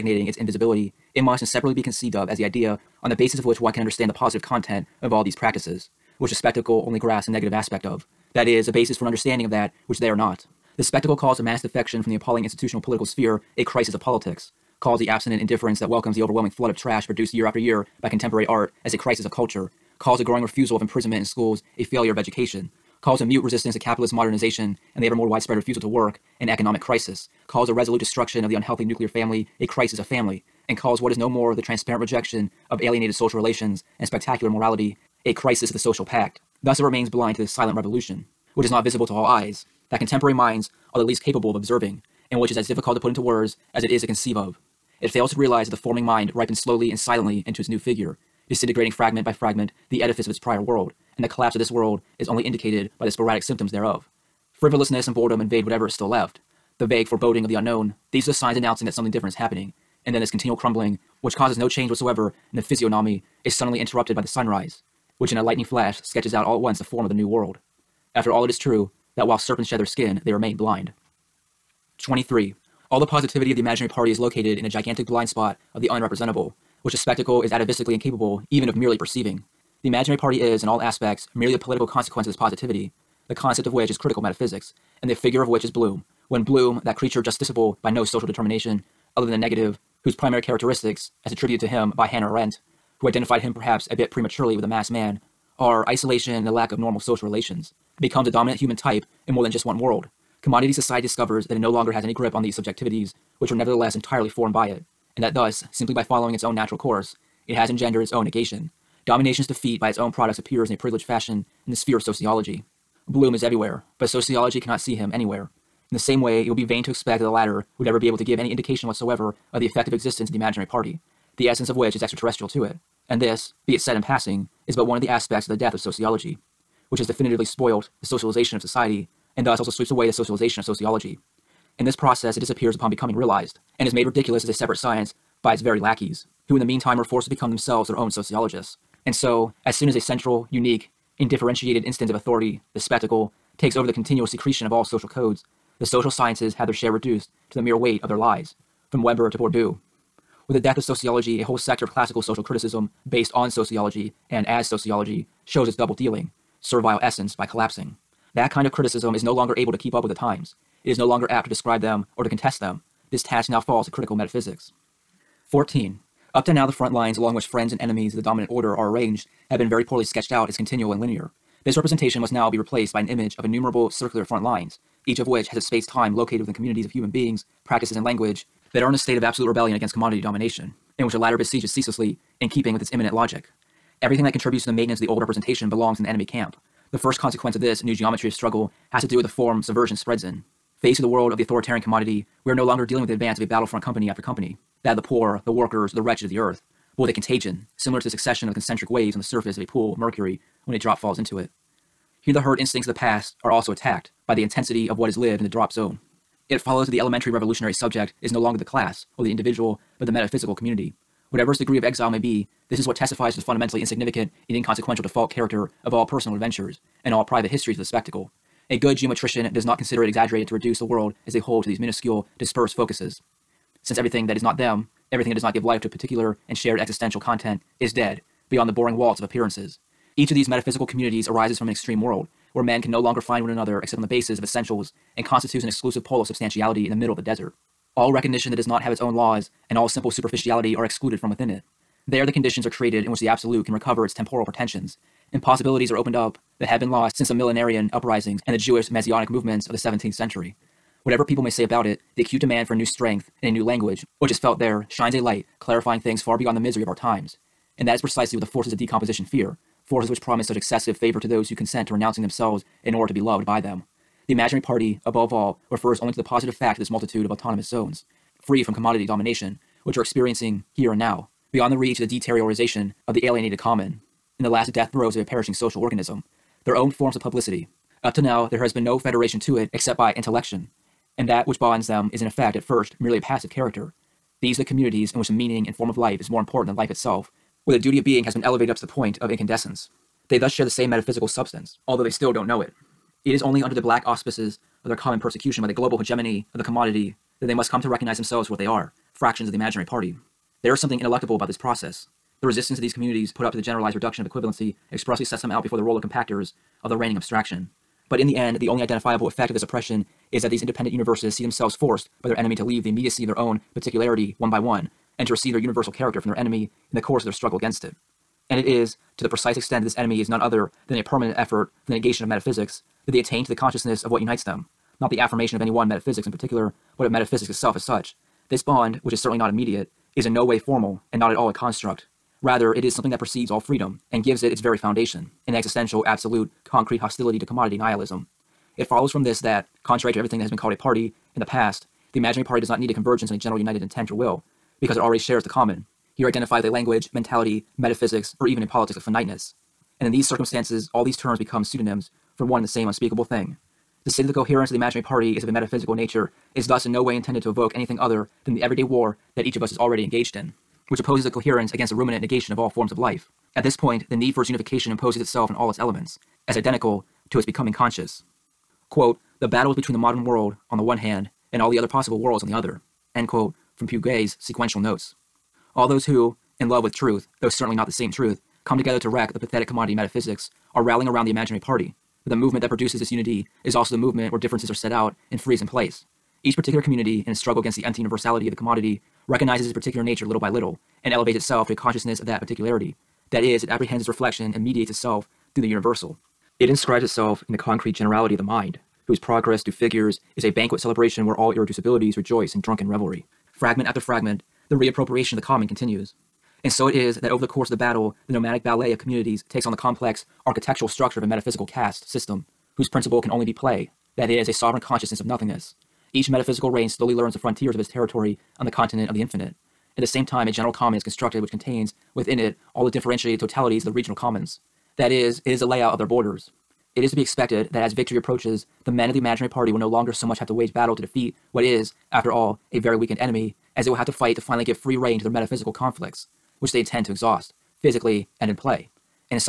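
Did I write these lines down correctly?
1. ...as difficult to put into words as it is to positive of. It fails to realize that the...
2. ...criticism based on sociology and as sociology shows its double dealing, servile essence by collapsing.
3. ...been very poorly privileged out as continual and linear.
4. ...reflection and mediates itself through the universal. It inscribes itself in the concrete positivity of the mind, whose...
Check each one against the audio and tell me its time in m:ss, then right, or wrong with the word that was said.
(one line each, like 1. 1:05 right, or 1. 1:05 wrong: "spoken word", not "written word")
1. 0:42 wrong: "conceive", not "positive"
2. 2:32 right
3. 2:49 wrong: "sketched", not "privileged"
4. 6:34 wrong: "generality", not "positivity".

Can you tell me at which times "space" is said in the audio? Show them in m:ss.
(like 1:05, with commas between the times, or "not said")
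2:55.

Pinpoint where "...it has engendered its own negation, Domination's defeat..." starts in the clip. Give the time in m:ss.
1:47.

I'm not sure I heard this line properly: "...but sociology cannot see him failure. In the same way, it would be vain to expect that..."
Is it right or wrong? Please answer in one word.
wrong.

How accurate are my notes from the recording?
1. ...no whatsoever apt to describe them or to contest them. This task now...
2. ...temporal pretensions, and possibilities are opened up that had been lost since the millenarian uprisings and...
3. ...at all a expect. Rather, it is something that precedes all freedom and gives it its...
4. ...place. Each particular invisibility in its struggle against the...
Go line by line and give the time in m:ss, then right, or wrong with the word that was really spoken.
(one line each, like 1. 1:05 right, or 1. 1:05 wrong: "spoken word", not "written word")
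1. 2:40 wrong: "longer", not "whatsoever"
2. 4:04 right
3. 5:31 wrong: "construct", not "expect"
4. 6:25 wrong: "community", not "invisibility".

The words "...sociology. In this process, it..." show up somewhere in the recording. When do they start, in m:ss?
2:10.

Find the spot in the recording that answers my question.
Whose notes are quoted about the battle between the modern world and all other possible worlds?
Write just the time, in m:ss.
6:13.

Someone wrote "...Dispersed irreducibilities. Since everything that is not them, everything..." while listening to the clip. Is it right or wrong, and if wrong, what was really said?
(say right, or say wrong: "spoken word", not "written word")
wrong: "focuses", not "irreducibilities".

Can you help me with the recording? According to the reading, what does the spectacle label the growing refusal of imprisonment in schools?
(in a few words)
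A failure of education.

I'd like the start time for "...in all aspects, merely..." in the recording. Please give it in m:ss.
1:20.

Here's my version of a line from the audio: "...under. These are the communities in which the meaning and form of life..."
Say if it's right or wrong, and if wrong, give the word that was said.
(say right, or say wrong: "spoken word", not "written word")
wrong: "character", not "under".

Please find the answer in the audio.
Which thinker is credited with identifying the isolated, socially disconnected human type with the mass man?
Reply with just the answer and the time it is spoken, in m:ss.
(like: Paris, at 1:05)
Hannah Arendt, at 1:32.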